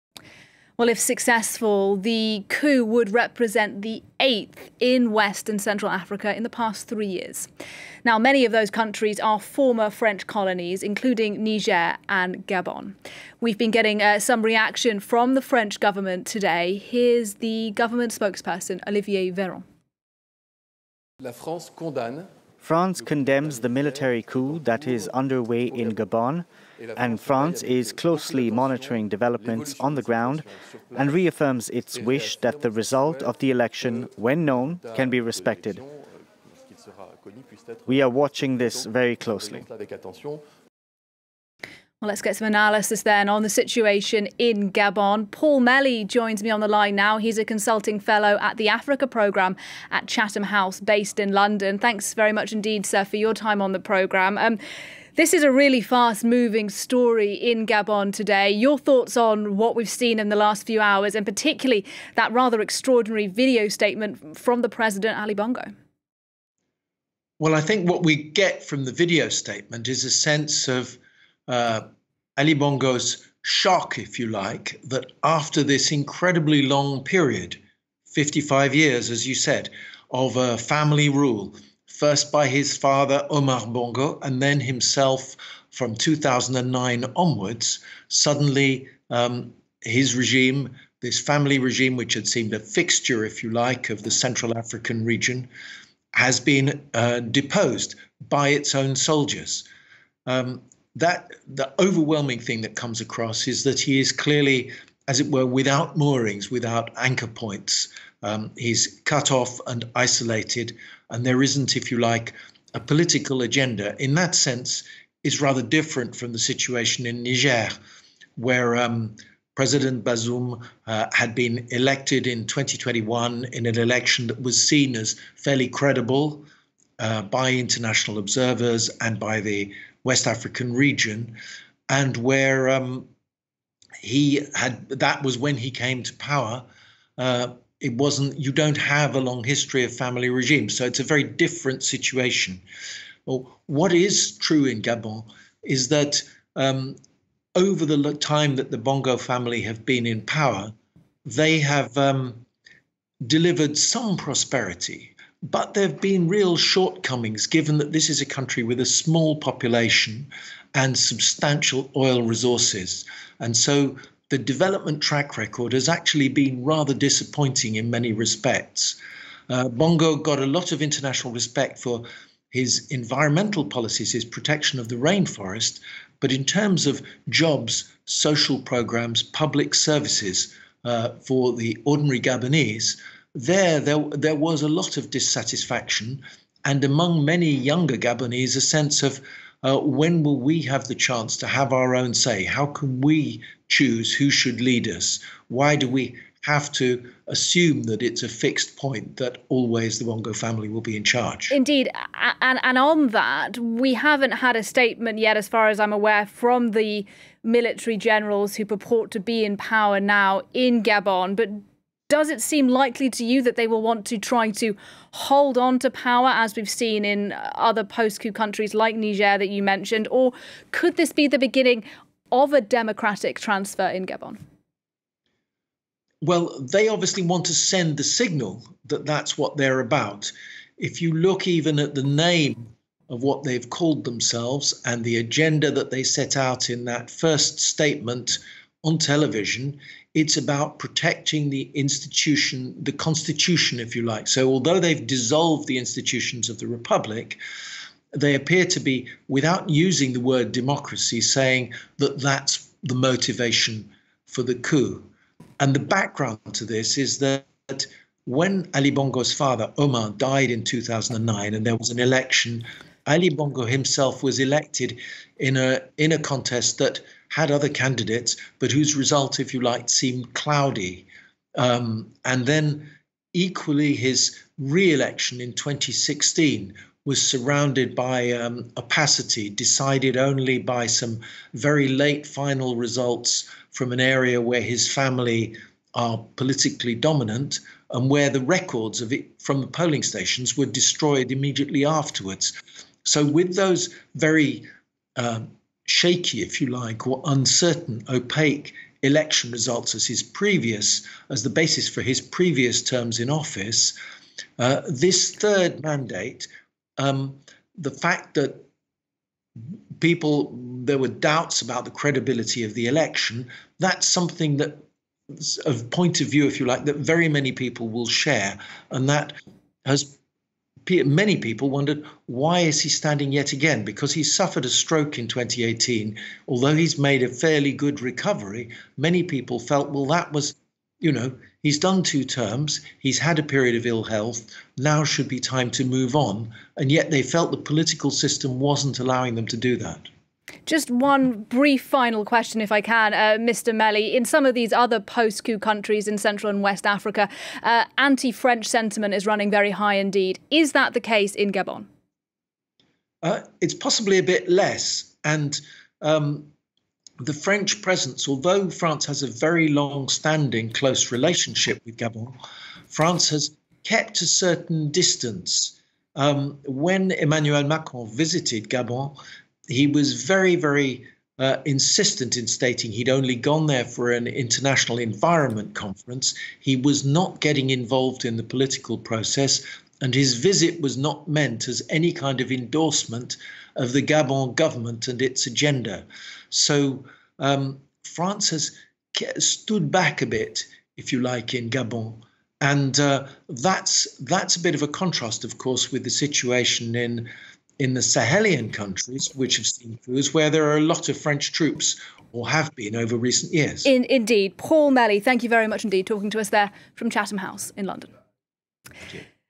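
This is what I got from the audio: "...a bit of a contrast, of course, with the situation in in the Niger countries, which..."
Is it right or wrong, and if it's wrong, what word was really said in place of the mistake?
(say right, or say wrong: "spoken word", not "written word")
wrong: "Sahelian", not "Niger".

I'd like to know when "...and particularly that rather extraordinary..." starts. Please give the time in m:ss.
1:01.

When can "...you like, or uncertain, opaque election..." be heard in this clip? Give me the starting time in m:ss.
4:56.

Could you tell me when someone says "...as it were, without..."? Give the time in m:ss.
1:45.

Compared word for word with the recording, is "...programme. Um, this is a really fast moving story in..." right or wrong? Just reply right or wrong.
right.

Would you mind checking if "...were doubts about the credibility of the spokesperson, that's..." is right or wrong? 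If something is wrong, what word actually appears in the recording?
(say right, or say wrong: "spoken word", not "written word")
wrong: "election", not "spokesperson".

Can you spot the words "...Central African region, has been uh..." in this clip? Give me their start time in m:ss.
1:34.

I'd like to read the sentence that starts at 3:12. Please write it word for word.
How can we choose who should lead us?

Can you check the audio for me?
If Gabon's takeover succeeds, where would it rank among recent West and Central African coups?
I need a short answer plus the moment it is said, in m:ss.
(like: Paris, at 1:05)
8th, at 0:04.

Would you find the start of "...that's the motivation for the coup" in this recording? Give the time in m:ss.
4:12.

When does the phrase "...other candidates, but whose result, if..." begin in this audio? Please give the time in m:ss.
4:27.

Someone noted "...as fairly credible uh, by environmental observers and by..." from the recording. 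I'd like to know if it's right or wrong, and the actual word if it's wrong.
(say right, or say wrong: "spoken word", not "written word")
wrong: "international", not "environmental".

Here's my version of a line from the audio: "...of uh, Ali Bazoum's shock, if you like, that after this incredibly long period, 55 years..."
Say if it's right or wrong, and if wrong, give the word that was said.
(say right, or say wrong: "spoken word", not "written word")
wrong: "Bongo", not "Bazoum".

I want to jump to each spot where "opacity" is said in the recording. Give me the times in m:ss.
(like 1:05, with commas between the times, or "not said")
4:38.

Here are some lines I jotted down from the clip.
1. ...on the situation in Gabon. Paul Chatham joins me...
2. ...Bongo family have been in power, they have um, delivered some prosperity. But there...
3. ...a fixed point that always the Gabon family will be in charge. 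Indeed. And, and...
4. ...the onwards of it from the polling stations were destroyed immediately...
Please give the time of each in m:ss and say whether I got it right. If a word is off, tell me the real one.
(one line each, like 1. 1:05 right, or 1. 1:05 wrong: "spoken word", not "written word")
1. 0:43 wrong: "Melly", not "Chatham"
2. 2:28 right
3. 3:18 wrong: "Bongo", not "Gabon"
4. 4:48 wrong: "records", not "onwards".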